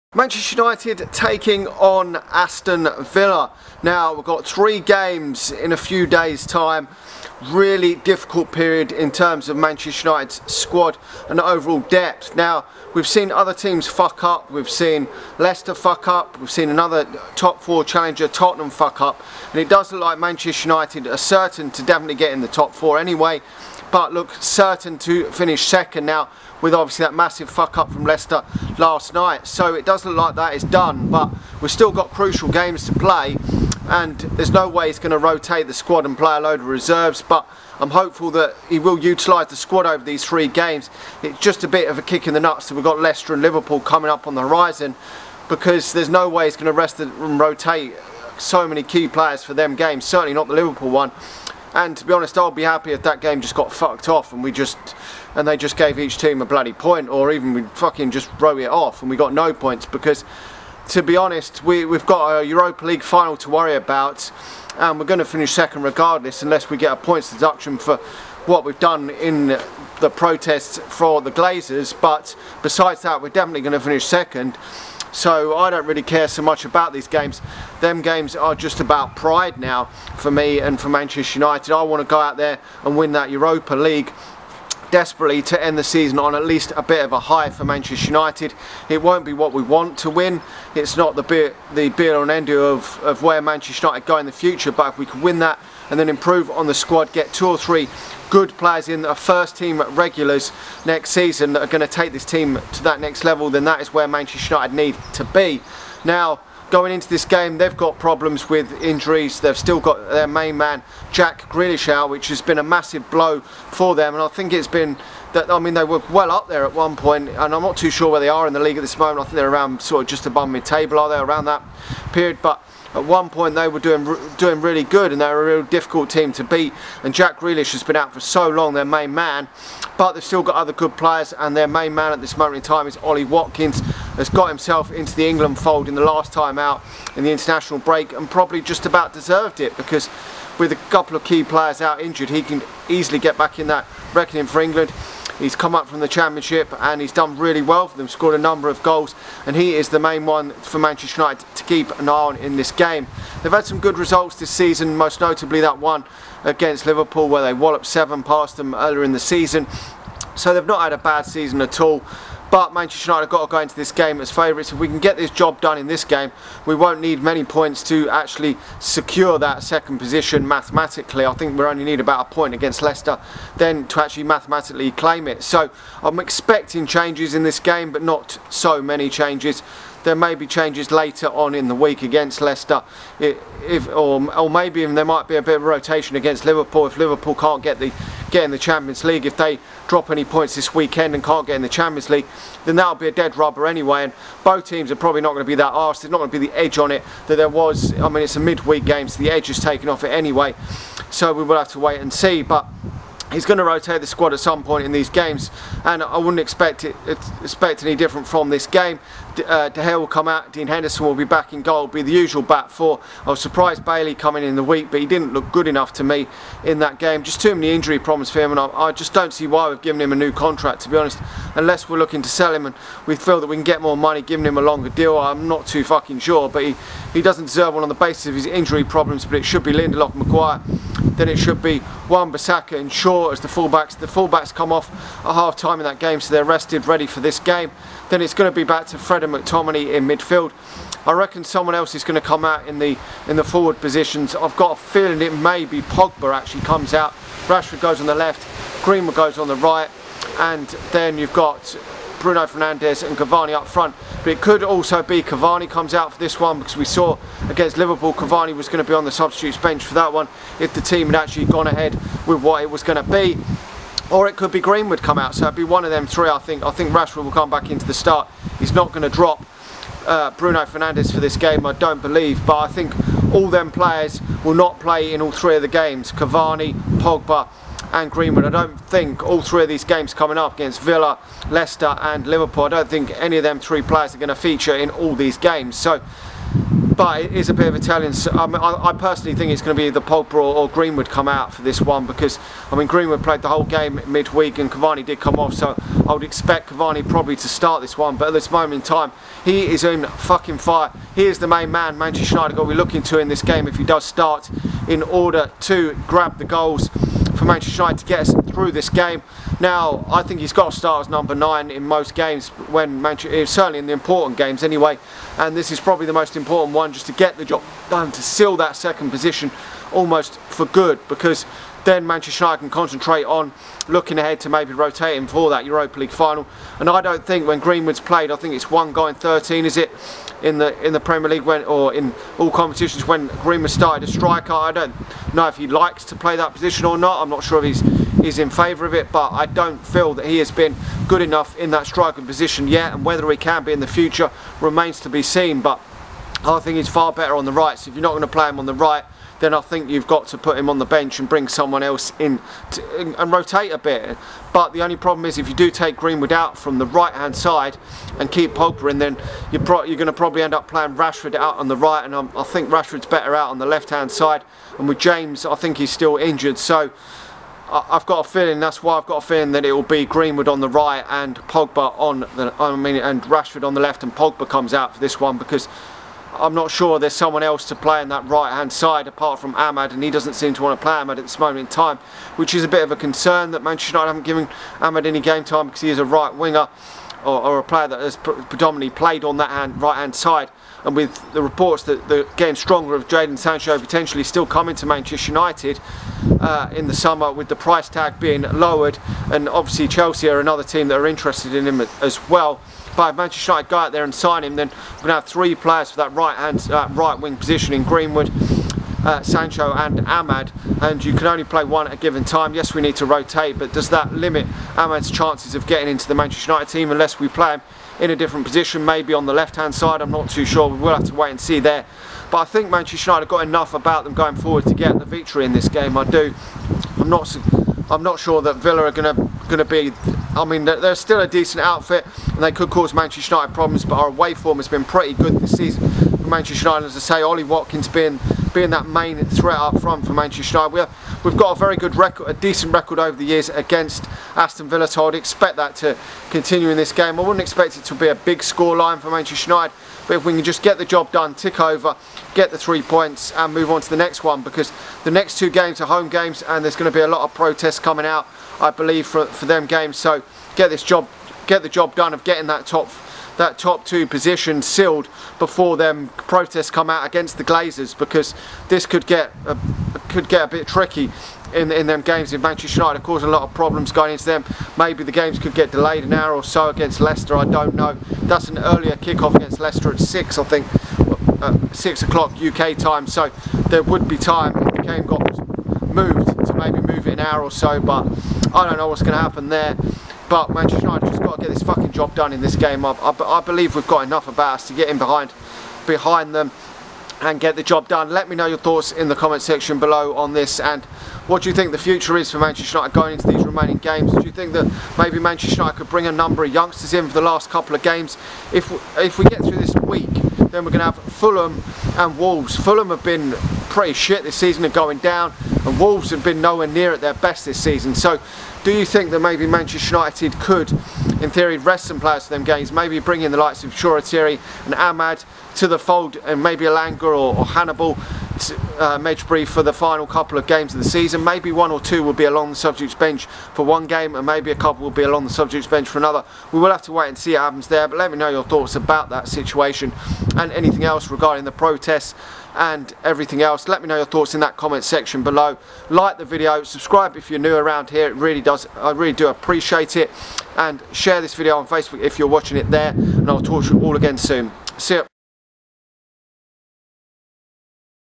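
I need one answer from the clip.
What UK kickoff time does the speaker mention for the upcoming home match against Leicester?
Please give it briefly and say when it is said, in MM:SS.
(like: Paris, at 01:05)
6 o'clock, at 08:01.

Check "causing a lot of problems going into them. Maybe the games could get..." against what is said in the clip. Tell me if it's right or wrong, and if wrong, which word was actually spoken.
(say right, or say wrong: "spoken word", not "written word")
right.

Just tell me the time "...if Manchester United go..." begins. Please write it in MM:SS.
06:43.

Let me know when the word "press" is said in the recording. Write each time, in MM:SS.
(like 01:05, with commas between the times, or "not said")
not said.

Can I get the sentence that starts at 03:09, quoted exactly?
If they drop any points this weekend and can't get in the Champions League, then that'll be a dead rubber anyway.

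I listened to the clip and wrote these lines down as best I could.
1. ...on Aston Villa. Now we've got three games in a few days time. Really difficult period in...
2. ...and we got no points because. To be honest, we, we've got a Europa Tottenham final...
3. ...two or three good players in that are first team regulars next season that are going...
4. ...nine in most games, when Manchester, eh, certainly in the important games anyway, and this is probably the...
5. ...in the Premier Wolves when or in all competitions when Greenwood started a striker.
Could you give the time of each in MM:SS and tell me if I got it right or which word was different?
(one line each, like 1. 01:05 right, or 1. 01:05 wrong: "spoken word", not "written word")
1. 00:01 right
2. 00:59 wrong: "League", not "Tottenham"
3. 01:37 right
4. 05:11 right
5. 05:30 wrong: "League", not "Wolves".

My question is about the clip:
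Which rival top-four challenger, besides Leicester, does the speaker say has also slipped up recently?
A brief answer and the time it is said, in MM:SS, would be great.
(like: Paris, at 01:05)
Tottenham, at 00:18.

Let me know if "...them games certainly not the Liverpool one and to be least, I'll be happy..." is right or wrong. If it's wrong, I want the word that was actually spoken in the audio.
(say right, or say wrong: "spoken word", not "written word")
wrong: "honest", not "least".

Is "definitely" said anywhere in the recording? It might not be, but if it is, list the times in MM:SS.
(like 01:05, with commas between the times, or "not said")
00:21, 01:13.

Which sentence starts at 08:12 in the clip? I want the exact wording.
I, I, I believe we've got enough about us to get in behind, behind them and get the job done.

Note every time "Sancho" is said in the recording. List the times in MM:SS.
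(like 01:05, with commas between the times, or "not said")
06:33, 06:49.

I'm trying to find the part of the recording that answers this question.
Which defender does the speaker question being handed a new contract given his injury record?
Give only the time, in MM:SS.
03:33.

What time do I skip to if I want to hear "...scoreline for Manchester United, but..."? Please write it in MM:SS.
07:28.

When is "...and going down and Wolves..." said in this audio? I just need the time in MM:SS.
08:34.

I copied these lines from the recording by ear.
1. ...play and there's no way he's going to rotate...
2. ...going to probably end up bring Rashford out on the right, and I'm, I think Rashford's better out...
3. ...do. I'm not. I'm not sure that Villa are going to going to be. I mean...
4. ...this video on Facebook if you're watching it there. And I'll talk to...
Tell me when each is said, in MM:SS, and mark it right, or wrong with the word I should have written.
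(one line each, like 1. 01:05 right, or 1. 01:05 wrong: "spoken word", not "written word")
1. 00:32 right
2. 05:59 wrong: "playing", not "bring"
3. 07:06 right
4. 09:11 right.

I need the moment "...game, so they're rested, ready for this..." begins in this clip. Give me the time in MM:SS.
03:55.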